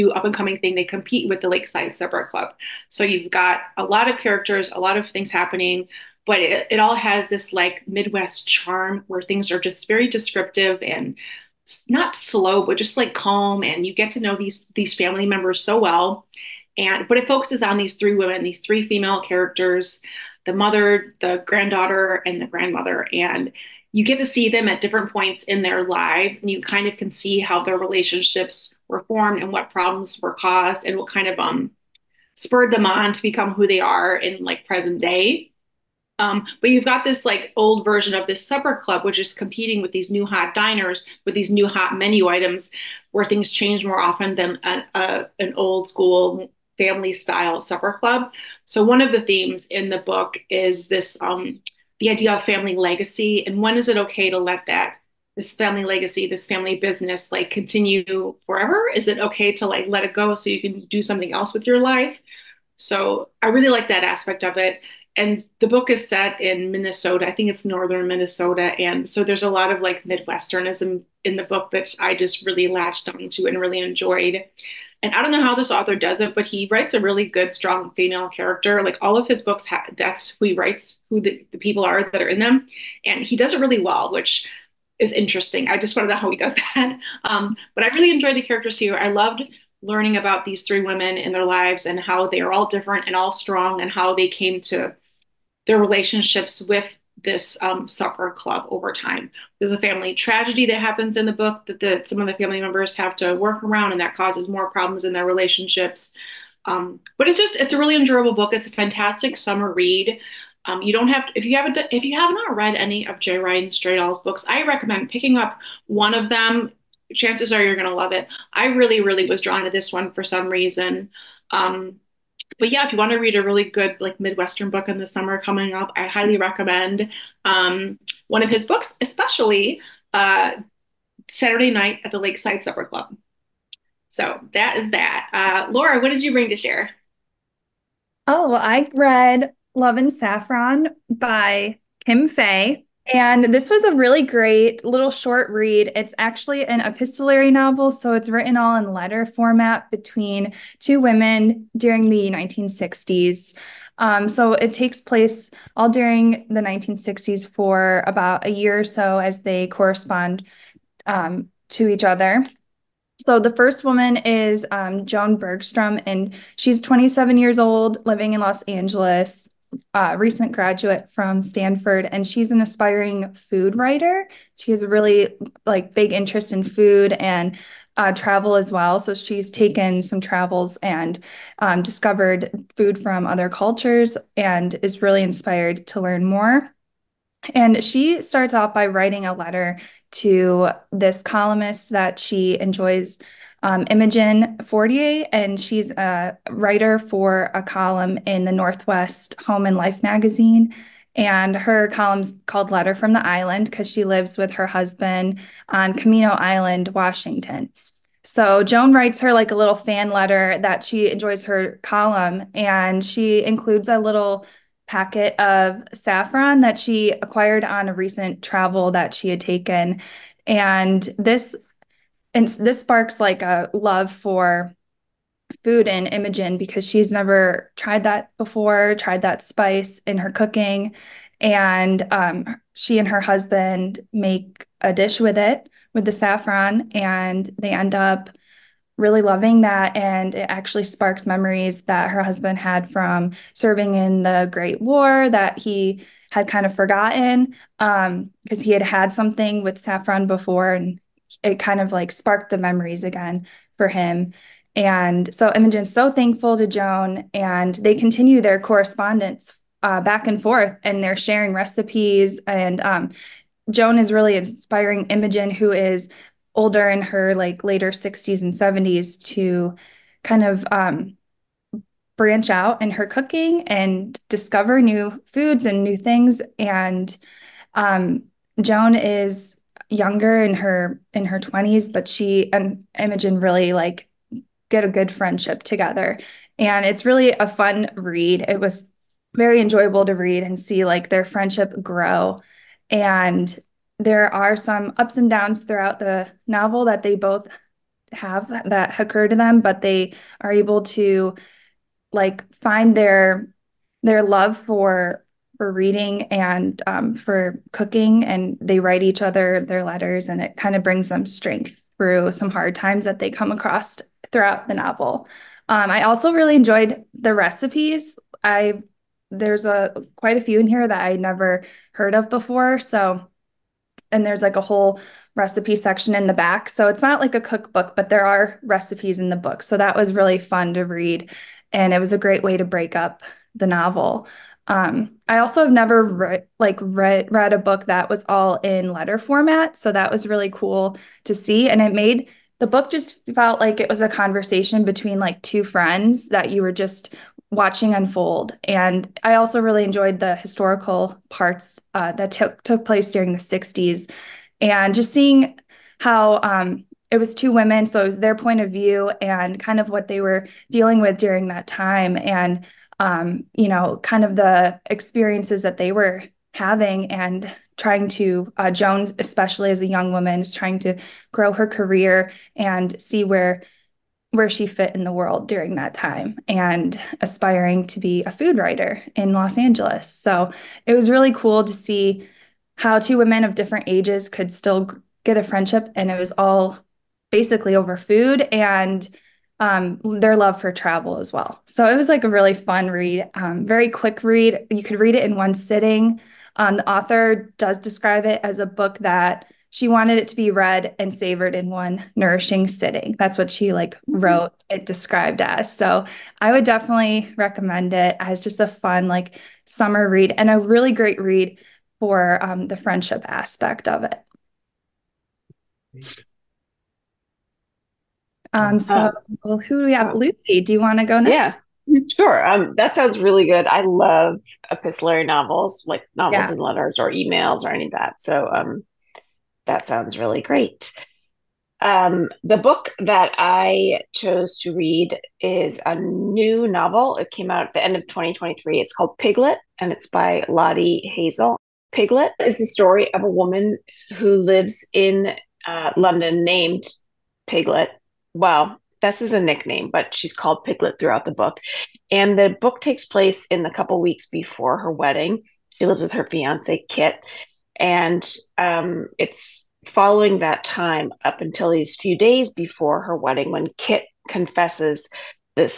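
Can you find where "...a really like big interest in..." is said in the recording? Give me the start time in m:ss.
2:54.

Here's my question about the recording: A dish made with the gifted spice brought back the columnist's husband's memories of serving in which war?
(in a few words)
the Great War.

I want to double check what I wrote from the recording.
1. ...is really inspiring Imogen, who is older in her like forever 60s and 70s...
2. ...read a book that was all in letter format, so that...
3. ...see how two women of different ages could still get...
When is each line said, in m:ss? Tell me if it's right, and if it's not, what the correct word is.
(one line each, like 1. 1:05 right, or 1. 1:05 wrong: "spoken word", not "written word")
1. 4:23 wrong: "later", not "forever"
2. 5:37 right
3. 6:21 right.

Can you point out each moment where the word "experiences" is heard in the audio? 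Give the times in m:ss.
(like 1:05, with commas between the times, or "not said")
6:04.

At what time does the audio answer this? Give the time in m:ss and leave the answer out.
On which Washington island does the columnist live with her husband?
3:25.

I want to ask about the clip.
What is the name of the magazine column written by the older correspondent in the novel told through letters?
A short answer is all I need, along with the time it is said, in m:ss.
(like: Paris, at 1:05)
Letter from the Island, at 3:22.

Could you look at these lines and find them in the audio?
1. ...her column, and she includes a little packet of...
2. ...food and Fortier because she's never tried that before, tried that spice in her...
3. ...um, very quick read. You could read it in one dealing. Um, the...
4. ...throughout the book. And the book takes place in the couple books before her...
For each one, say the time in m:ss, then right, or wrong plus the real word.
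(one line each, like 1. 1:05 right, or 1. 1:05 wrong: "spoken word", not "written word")
1. 3:31 right
2. 3:45 wrong: "Imogen", not "Fortier"
3. 6:33 wrong: "sitting", not "dealing"
4. 7:30 wrong: "weeks", not "books".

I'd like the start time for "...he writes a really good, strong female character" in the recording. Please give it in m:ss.
1:16.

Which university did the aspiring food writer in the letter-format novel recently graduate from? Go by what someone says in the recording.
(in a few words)
Stanford.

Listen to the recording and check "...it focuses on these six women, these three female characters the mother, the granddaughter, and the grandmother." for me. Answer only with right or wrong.
wrong.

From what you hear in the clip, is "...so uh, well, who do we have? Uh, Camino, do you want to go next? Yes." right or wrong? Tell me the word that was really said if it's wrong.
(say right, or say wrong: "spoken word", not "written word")
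wrong: "Lucy", not "Camino".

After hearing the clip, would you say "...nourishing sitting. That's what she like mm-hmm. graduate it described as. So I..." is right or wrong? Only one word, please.
wrong.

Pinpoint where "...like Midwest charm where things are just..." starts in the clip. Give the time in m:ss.
0:07.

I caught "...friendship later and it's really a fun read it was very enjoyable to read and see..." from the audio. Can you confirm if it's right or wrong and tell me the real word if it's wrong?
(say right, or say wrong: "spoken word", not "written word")
wrong: "together", not "later".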